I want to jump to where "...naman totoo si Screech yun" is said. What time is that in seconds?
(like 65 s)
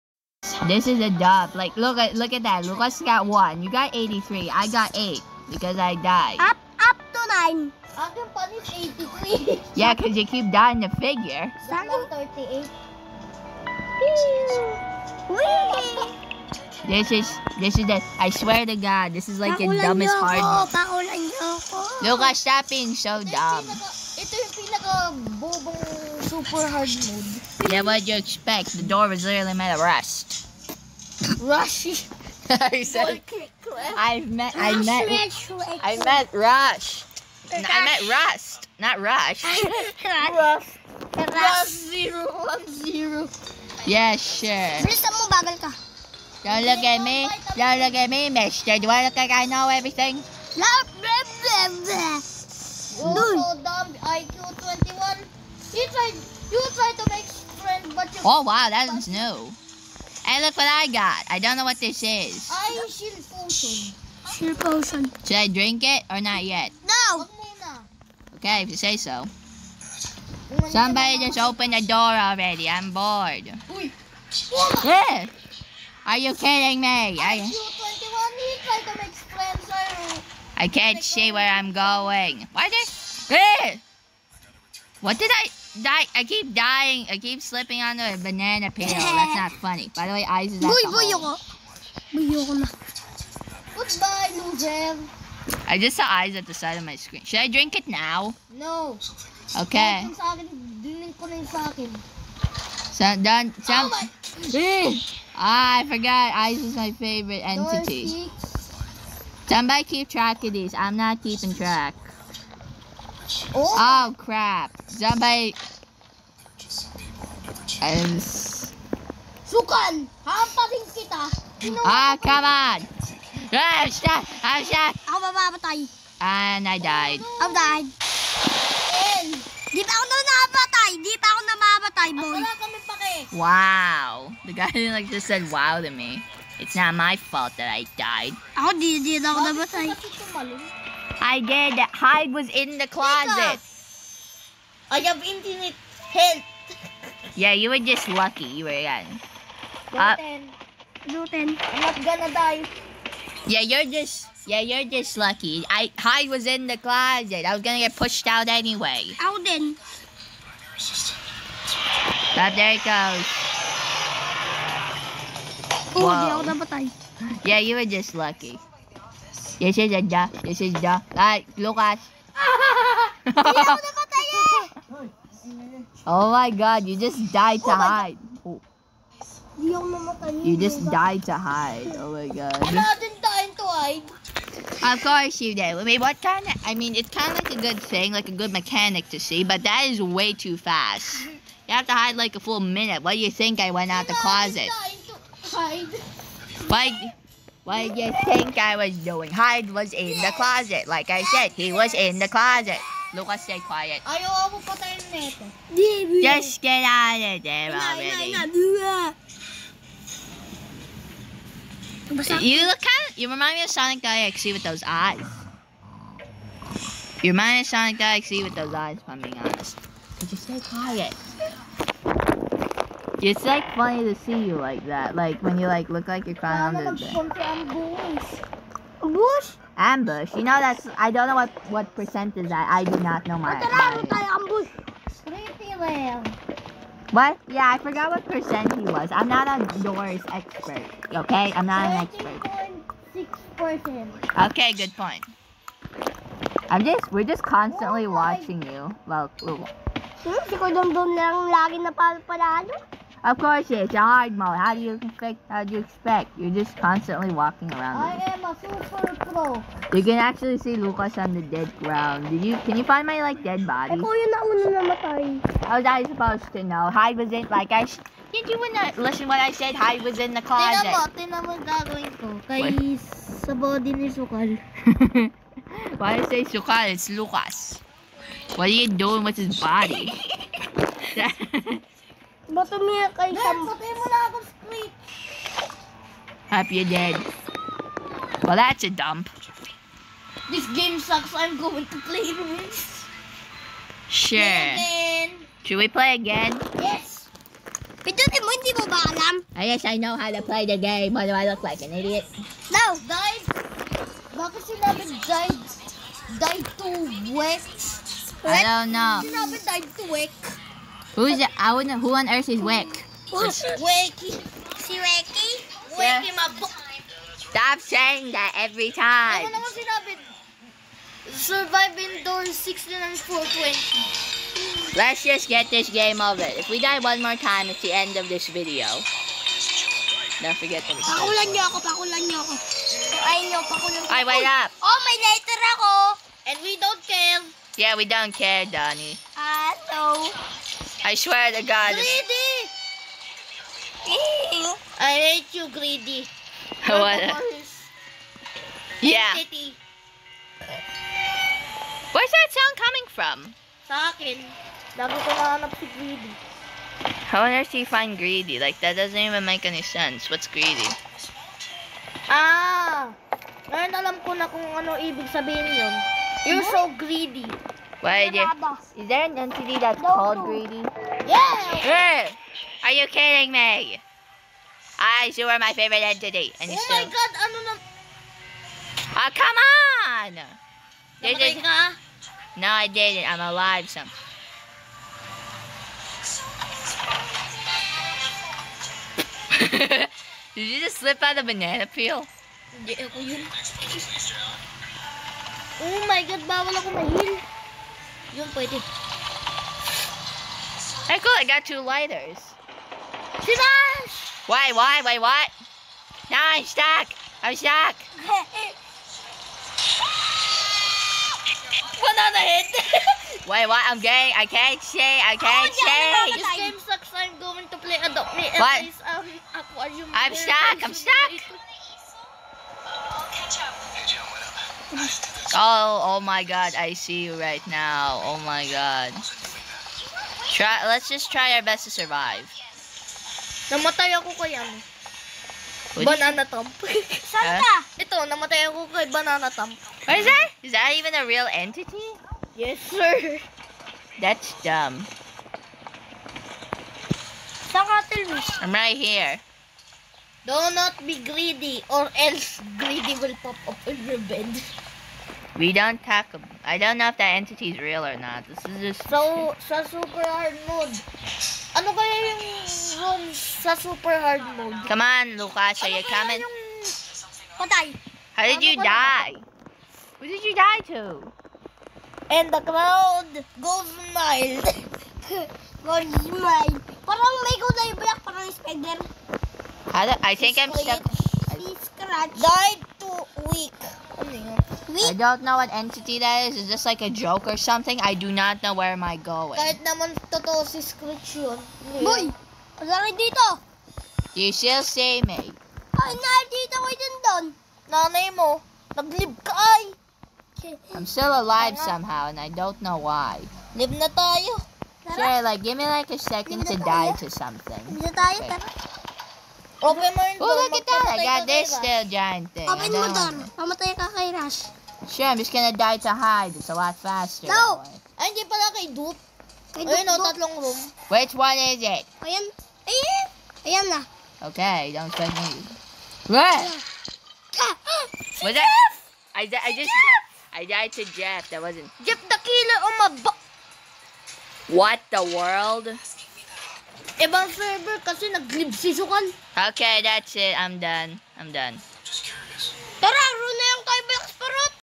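489 s.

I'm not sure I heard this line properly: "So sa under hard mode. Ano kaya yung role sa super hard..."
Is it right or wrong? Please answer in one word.
wrong.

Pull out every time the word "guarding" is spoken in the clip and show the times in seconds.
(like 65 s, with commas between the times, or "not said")
not said.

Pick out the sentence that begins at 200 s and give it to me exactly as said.
Like I said, he was in the closet.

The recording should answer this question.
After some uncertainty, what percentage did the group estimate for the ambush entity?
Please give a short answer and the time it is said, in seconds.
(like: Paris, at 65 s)
6 percent, at 243 s.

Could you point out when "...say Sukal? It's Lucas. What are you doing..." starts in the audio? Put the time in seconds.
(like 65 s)
276 s.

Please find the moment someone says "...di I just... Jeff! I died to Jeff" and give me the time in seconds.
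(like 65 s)
529 s.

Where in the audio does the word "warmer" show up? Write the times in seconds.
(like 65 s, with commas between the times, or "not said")
not said.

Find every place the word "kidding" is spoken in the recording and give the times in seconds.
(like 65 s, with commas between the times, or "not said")
76 s, 373 s.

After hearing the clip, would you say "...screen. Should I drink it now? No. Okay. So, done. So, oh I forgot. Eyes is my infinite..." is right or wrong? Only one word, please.
wrong.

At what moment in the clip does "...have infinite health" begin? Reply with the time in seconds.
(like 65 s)
144 s.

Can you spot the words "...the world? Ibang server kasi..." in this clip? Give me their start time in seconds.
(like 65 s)
535 s.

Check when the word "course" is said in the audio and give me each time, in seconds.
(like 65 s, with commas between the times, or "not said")
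185 s, 253 s.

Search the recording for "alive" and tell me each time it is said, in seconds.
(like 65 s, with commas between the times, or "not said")
383 s, 501 s.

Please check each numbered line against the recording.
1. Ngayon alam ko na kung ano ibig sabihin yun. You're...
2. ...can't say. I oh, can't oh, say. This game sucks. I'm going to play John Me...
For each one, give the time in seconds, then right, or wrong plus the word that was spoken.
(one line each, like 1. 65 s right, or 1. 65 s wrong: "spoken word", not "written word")
1. 363 s right
2. 414 s wrong: "Adopt", not "John".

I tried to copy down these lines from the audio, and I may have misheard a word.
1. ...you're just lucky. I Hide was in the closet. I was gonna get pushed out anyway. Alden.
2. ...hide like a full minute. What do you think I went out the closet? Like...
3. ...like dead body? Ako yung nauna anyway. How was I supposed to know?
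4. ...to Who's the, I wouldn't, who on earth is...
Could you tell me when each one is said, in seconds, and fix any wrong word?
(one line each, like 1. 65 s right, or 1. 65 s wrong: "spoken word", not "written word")
1. 154 s right
2. 191 s right
3. 263 s wrong: "namatay", not "anyway"
4. 310 s right.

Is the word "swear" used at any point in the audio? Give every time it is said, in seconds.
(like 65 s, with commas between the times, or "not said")
18 s, 341 s.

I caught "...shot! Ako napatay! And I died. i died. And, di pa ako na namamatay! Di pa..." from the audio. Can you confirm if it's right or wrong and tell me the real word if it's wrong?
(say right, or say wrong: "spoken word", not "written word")
wrong: "mamamatay", not "napatay".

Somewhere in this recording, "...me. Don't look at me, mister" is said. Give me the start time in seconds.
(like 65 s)
47 s.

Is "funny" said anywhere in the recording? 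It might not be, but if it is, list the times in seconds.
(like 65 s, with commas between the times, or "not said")
89 s, 223 s.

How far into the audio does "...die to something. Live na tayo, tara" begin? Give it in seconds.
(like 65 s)
506 s.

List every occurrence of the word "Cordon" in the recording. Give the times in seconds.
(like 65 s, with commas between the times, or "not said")
250 s.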